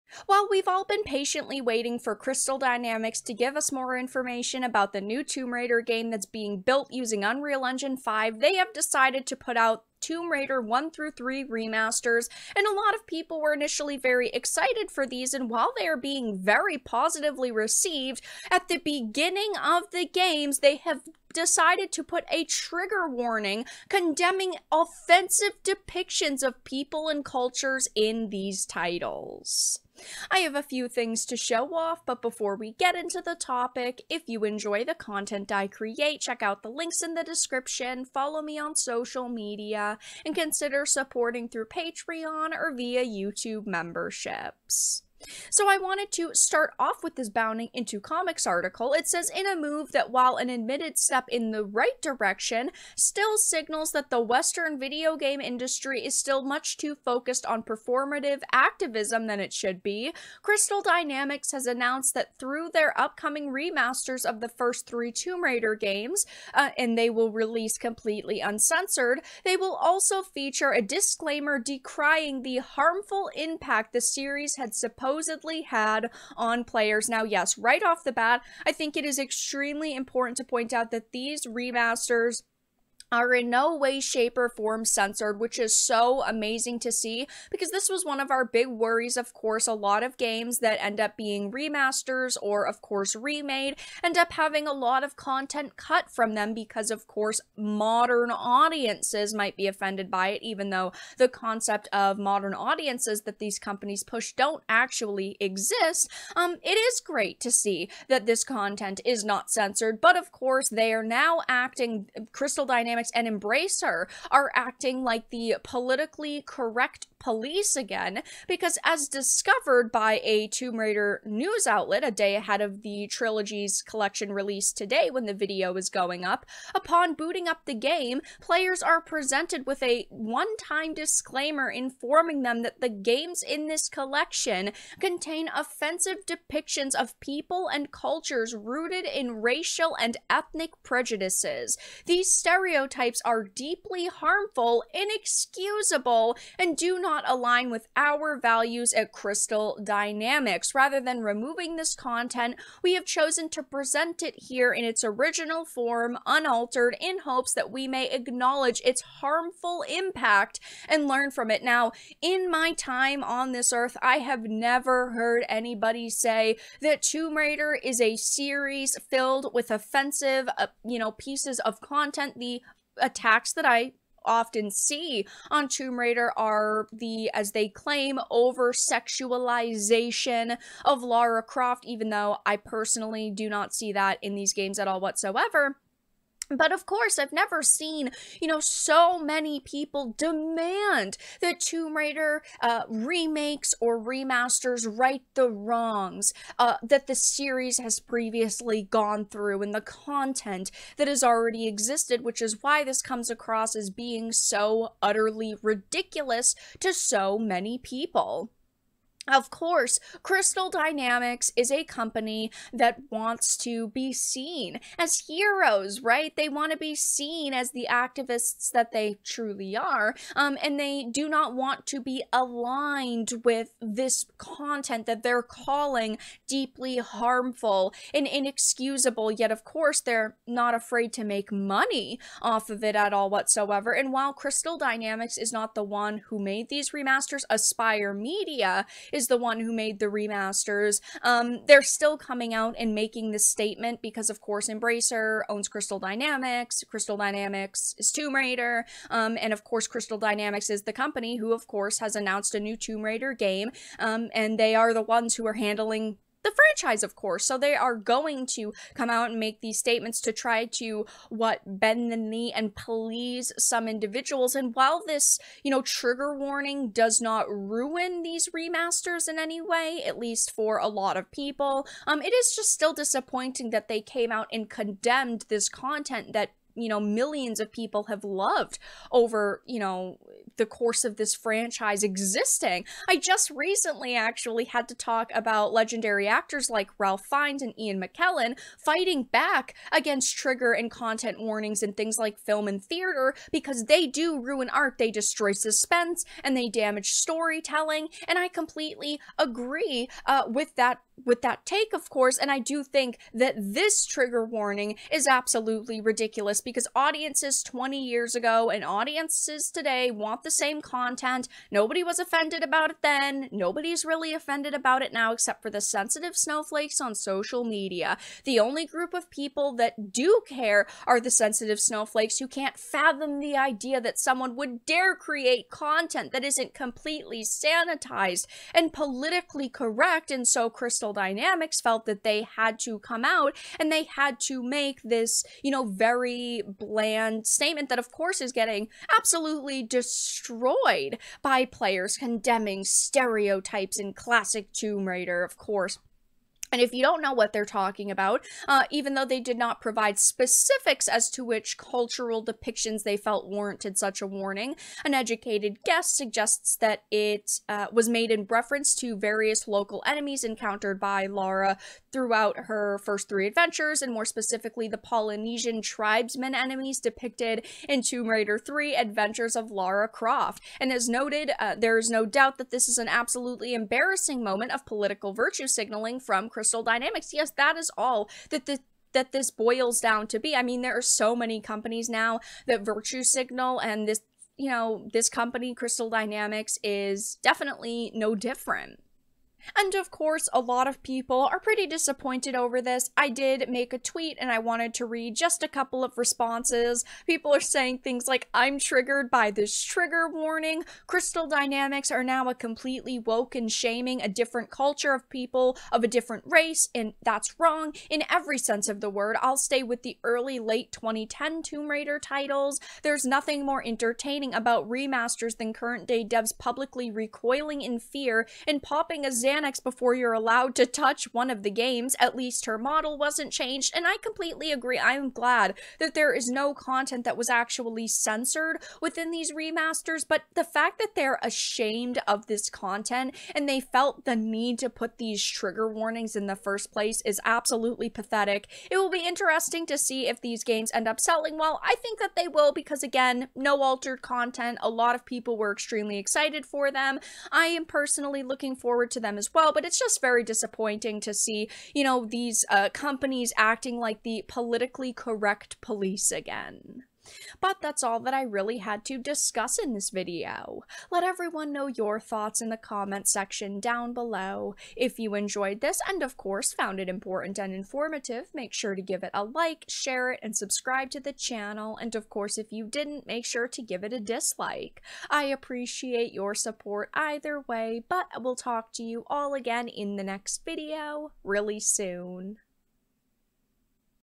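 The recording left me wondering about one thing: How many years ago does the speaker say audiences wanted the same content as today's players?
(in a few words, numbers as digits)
20.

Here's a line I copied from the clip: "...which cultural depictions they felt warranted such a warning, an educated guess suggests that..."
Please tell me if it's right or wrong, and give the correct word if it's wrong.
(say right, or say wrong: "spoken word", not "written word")
right.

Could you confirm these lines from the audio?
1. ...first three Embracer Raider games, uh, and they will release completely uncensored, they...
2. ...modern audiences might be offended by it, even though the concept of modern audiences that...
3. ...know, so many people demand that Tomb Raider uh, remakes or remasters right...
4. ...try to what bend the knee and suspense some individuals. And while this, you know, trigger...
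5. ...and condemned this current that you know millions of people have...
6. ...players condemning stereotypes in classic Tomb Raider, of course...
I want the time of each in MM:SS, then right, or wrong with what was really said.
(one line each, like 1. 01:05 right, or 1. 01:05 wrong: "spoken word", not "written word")
1. 01:04 wrong: "Tomb", not "Embracer"
2. 01:37 right
3. 03:08 right
4. 04:20 wrong: "please", not "suspense"
5. 04:34 wrong: "content", not "current"
6. 05:41 right.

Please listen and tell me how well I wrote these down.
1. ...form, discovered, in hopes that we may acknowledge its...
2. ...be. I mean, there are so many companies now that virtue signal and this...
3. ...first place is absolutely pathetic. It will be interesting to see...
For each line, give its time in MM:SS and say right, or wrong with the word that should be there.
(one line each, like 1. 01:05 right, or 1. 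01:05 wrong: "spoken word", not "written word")
1. 02:35 wrong: "unaltered", not "discovered"
2. 06:20 right
3. 07:16 right.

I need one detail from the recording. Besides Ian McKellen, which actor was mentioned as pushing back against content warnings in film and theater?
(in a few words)
Ralph Fiennes.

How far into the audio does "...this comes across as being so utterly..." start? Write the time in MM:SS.
03:22.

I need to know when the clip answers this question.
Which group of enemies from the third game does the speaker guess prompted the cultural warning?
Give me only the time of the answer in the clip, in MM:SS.
06:04.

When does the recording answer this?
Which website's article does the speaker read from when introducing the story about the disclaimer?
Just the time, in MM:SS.
00:47.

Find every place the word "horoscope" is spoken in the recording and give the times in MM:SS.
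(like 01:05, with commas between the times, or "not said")
not said.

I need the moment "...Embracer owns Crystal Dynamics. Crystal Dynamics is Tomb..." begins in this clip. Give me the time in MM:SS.
04:04.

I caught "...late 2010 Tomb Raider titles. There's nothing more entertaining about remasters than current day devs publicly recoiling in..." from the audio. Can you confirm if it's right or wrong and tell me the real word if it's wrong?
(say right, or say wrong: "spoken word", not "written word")
right.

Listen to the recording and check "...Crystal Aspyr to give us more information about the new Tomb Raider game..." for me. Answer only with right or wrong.
wrong.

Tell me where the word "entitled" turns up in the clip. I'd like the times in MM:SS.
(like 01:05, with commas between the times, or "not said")
not said.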